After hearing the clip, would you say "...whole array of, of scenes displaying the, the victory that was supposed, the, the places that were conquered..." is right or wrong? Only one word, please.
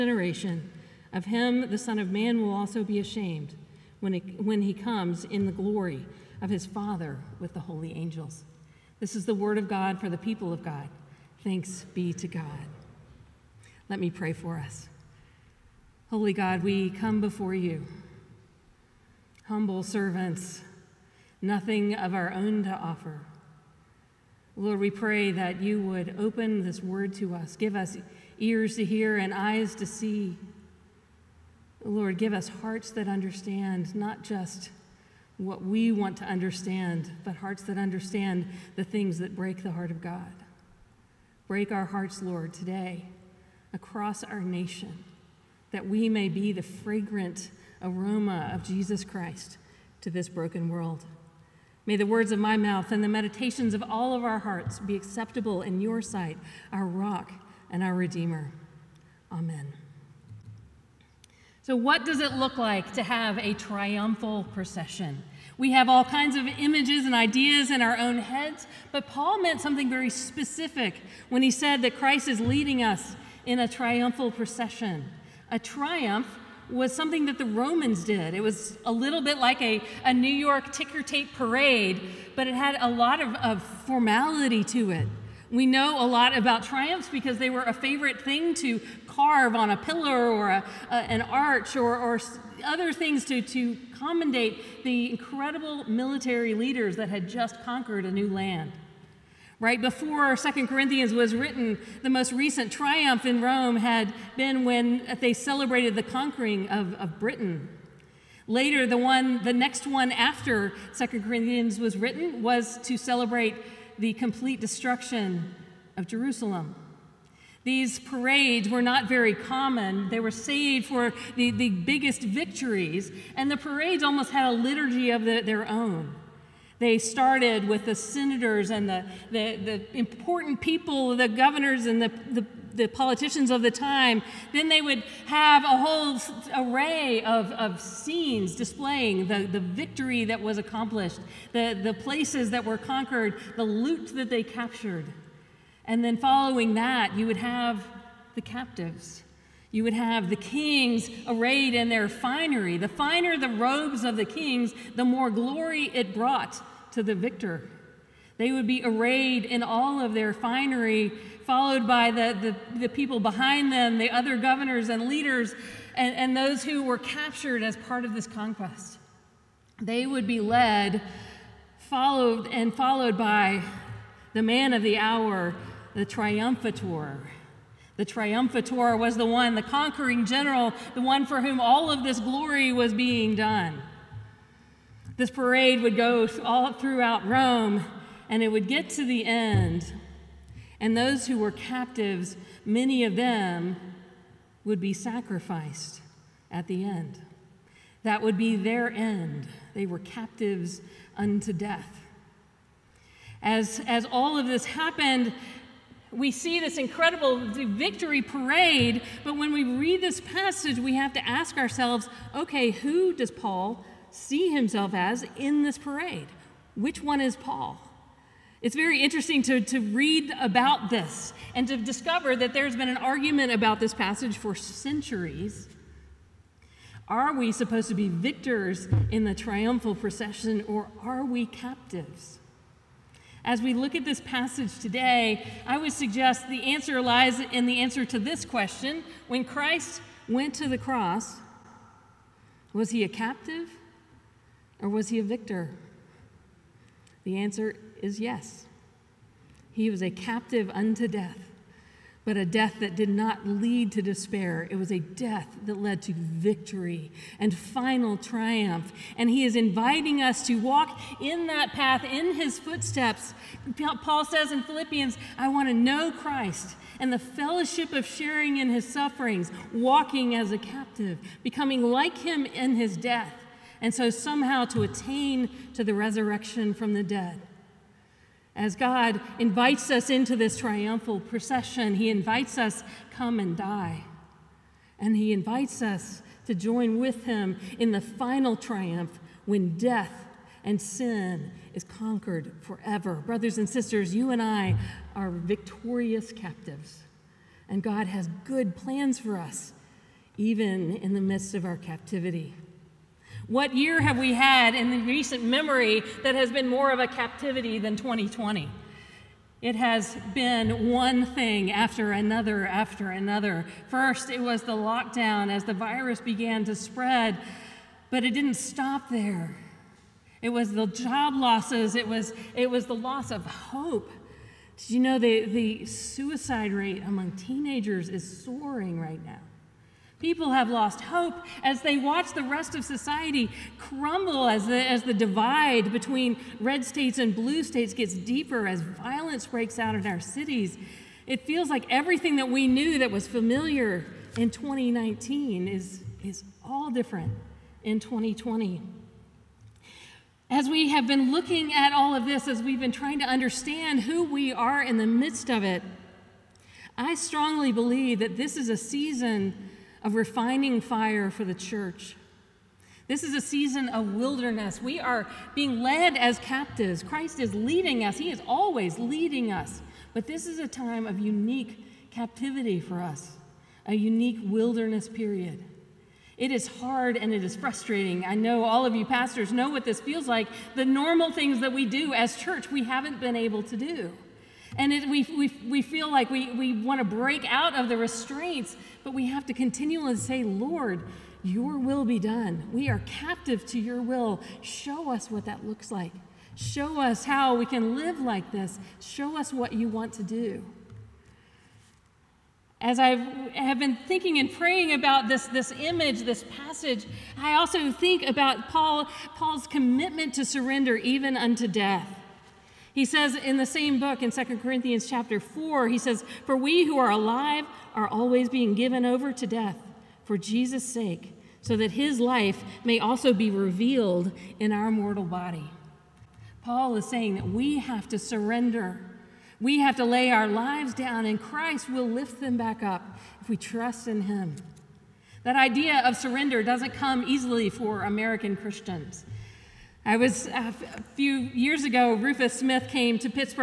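wrong.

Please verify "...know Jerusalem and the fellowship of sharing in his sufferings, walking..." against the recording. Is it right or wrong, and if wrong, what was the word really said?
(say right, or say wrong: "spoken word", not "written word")
wrong: "Christ", not "Jerusalem".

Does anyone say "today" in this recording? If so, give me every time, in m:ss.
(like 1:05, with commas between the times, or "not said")
0:42, 3:54.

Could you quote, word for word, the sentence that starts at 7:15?
That idea of surrender doesn't come easily for American Christians.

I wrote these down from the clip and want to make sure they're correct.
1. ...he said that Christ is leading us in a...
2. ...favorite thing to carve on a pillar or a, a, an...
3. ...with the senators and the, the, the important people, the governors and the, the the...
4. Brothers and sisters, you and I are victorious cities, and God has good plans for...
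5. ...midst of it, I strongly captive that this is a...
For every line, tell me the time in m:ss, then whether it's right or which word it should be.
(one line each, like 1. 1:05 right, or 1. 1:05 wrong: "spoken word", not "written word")
1. 1:11 right
2. 1:27 right
3. 2:07 right
4. 4:53 wrong: "captives", not "cities"
5. 5:55 wrong: "believe", not "captive".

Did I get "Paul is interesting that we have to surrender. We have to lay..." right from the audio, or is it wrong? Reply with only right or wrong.
wrong.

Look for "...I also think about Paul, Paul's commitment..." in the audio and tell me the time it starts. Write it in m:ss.
6:47.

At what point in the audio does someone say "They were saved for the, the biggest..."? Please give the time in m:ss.
2:00.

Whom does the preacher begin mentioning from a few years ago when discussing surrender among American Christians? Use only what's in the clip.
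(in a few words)
Rufus Smith.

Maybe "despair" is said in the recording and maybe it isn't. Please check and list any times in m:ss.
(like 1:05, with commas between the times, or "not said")
4:14.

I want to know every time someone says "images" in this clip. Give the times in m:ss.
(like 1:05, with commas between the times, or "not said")
1:06, 6:45.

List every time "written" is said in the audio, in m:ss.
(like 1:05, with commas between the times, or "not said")
1:41, 1:51.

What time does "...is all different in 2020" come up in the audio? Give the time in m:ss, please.
5:46.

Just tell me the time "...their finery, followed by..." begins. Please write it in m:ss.
2:40.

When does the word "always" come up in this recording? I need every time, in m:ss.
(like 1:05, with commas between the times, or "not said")
6:08, 6:58.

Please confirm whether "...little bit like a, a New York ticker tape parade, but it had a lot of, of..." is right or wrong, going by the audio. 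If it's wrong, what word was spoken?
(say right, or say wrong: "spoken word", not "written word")
right.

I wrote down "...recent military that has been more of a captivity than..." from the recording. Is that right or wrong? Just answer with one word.
wrong.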